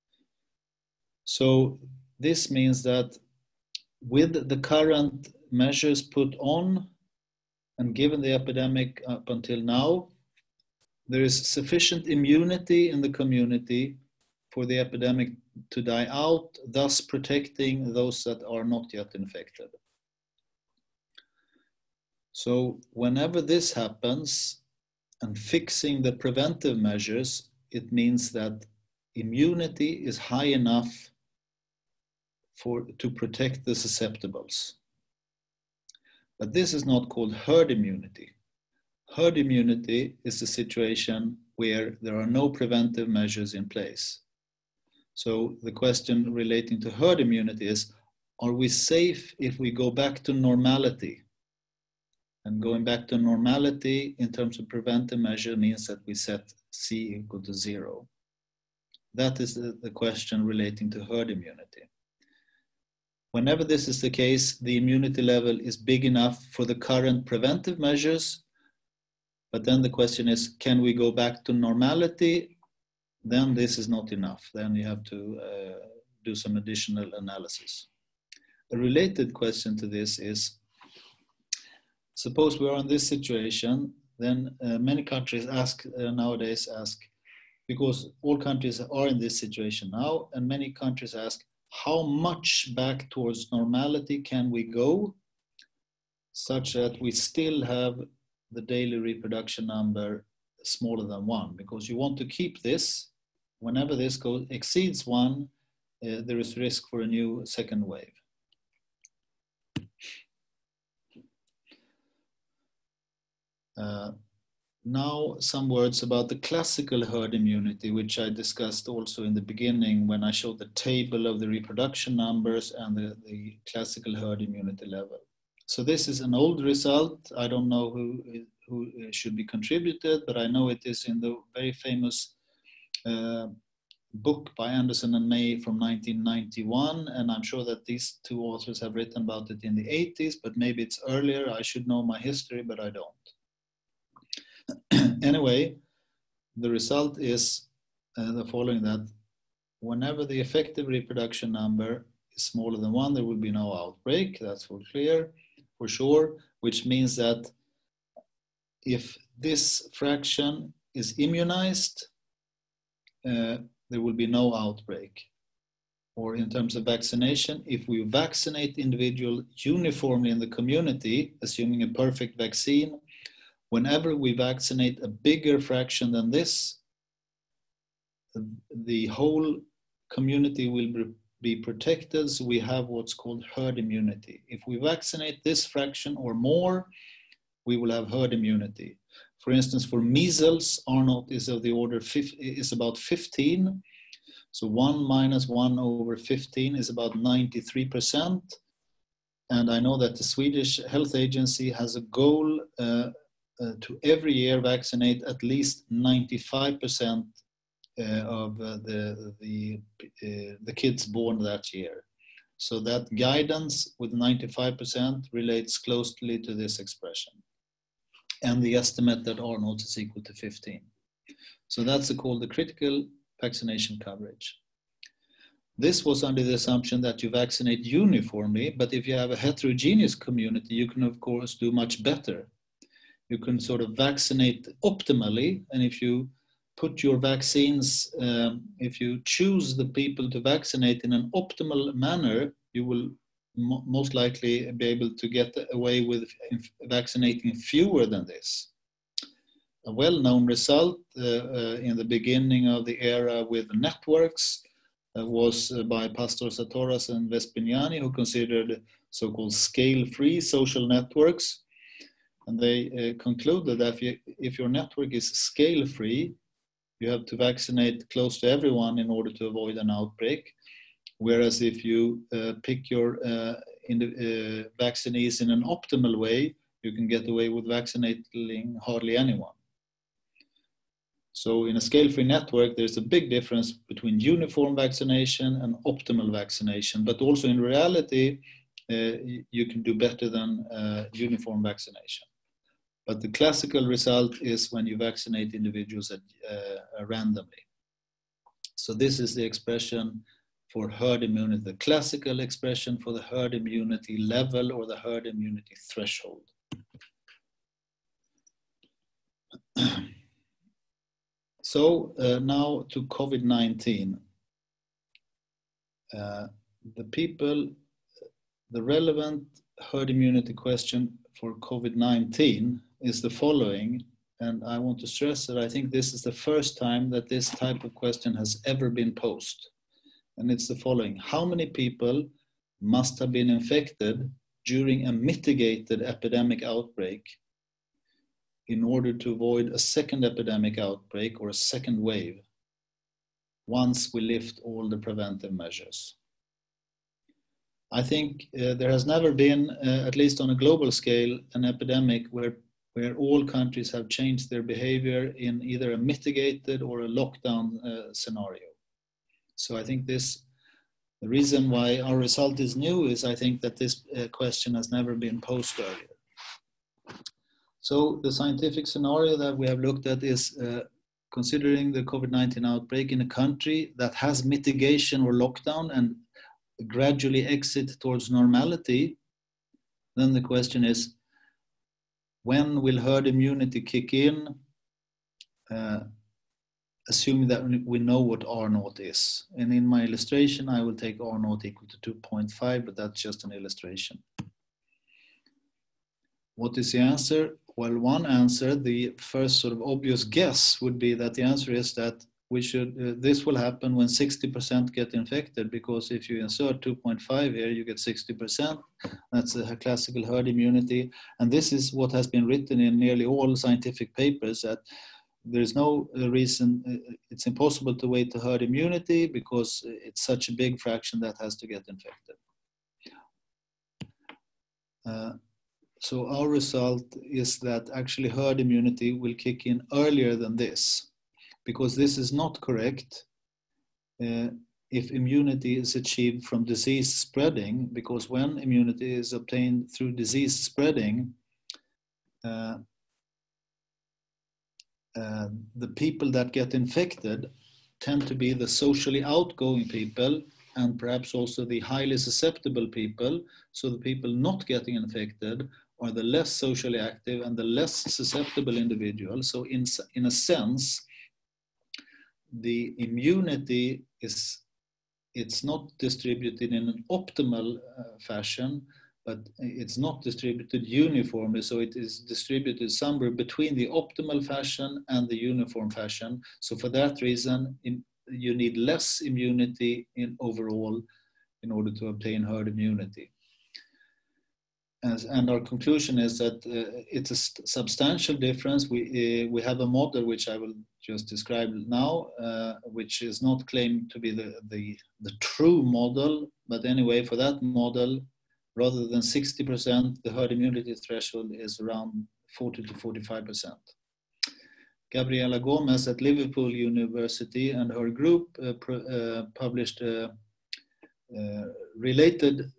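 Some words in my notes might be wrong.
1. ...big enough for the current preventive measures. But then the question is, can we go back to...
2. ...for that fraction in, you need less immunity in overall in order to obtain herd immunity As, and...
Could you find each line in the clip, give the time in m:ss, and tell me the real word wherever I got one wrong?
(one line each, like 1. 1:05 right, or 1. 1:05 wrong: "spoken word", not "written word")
1. 1:05 right
2. 7:56 wrong: "reason", not "fraction".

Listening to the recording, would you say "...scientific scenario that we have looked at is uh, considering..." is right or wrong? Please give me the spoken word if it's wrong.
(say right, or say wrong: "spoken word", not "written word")
right.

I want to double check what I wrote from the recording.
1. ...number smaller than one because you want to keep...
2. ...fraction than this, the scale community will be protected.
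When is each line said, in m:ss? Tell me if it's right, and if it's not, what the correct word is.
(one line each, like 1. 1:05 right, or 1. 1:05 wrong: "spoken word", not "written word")
1. 1:39 right
2. 2:55 wrong: "whole", not "scale".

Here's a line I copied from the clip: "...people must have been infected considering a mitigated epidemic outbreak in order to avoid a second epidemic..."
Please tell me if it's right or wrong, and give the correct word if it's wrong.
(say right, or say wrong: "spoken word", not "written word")
wrong: "during", not "considering".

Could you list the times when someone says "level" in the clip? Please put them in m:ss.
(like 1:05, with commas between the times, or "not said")
1:05, 2:04, 5:04.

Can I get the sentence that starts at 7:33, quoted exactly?
So the people not getting infected are the less socially active and the less susceptible individuals.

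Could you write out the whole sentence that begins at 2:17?
And I'm sure that these two authors have written about it in the 80s, but maybe it's earlier.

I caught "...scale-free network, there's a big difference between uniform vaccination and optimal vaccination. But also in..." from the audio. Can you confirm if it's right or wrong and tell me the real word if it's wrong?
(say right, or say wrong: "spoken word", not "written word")
right.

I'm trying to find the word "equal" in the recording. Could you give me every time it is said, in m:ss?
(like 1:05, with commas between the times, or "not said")
0:57, 3:39, 6:31.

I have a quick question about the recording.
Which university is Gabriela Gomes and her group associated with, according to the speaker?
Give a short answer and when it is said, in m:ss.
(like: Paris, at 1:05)
Liverpool University, at 8:26.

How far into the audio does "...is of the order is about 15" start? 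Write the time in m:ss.
3:11.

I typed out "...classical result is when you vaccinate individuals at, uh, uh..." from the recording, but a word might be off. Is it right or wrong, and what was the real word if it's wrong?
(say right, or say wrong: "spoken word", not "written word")
right.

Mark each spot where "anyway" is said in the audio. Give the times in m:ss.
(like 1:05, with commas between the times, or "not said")
2:25, 8:16.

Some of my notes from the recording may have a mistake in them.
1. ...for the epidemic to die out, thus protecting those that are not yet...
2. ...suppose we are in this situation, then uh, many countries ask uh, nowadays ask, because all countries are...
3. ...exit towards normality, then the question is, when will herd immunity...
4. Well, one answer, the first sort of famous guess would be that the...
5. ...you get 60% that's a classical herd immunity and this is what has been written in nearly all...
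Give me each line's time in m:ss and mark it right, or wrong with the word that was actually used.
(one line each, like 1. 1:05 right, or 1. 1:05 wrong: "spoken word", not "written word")
1. 0:14 right
2. 1:22 right
3. 6:17 right
4. 6:37 wrong: "obvious", not "famous"
5. 6:47 right.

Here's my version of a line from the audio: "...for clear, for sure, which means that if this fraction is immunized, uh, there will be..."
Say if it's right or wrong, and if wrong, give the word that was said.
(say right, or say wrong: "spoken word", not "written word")
right.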